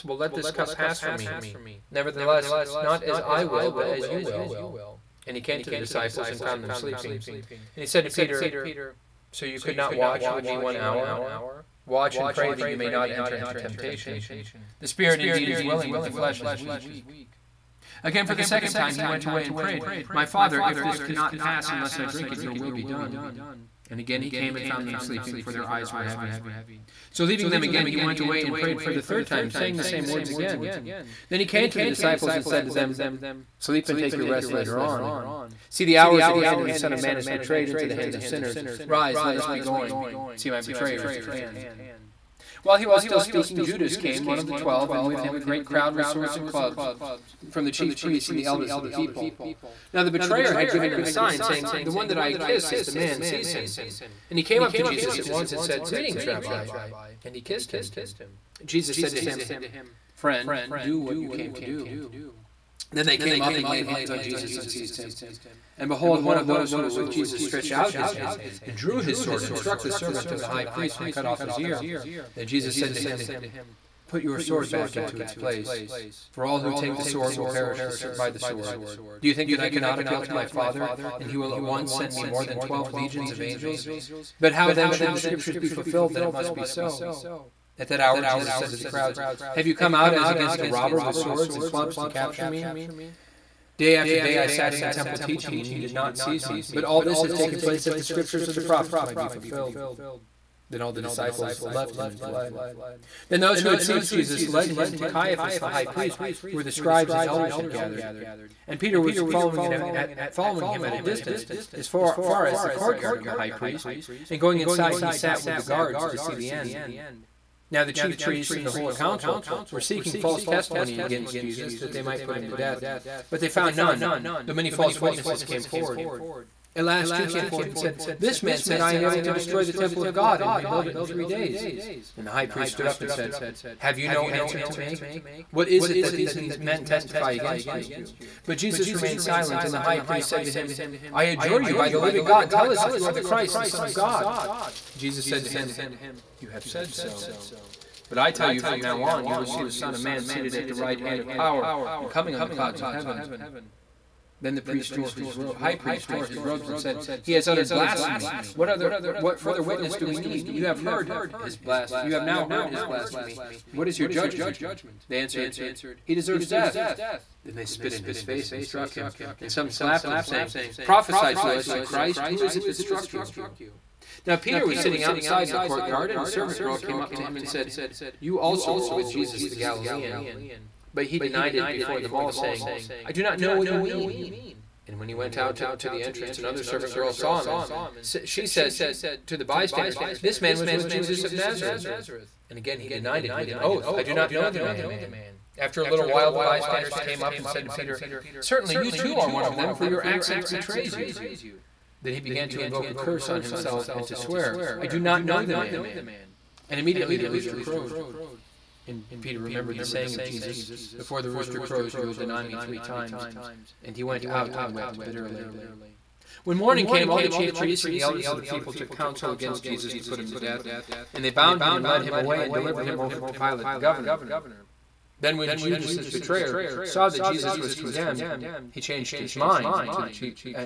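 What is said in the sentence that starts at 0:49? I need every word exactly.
Now the betrayer had given them a sign, saying, The one that I kiss is the man, seize him.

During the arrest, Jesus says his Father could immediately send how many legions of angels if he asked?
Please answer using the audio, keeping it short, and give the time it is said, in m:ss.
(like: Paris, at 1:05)
12 legions, at 1:22.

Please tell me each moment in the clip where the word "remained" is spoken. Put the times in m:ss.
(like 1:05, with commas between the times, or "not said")
2:18.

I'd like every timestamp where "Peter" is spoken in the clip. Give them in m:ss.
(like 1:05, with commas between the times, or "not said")
0:08, 1:48, 2:54, 3:17, 3:29.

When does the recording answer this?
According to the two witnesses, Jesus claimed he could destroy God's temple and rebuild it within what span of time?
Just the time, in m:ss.
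2:11.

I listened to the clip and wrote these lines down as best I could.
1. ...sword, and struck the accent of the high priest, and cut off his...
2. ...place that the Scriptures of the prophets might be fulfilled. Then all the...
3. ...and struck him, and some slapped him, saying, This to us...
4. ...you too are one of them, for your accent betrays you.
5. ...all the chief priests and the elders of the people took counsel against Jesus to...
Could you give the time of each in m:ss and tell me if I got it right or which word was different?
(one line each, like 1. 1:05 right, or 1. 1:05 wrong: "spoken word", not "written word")
1. 1:09 wrong: "servant", not "accent"
2. 1:37 right
3. 2:48 wrong: "Prophesy", not "This"
4. 3:18 right
5. 3:37 right.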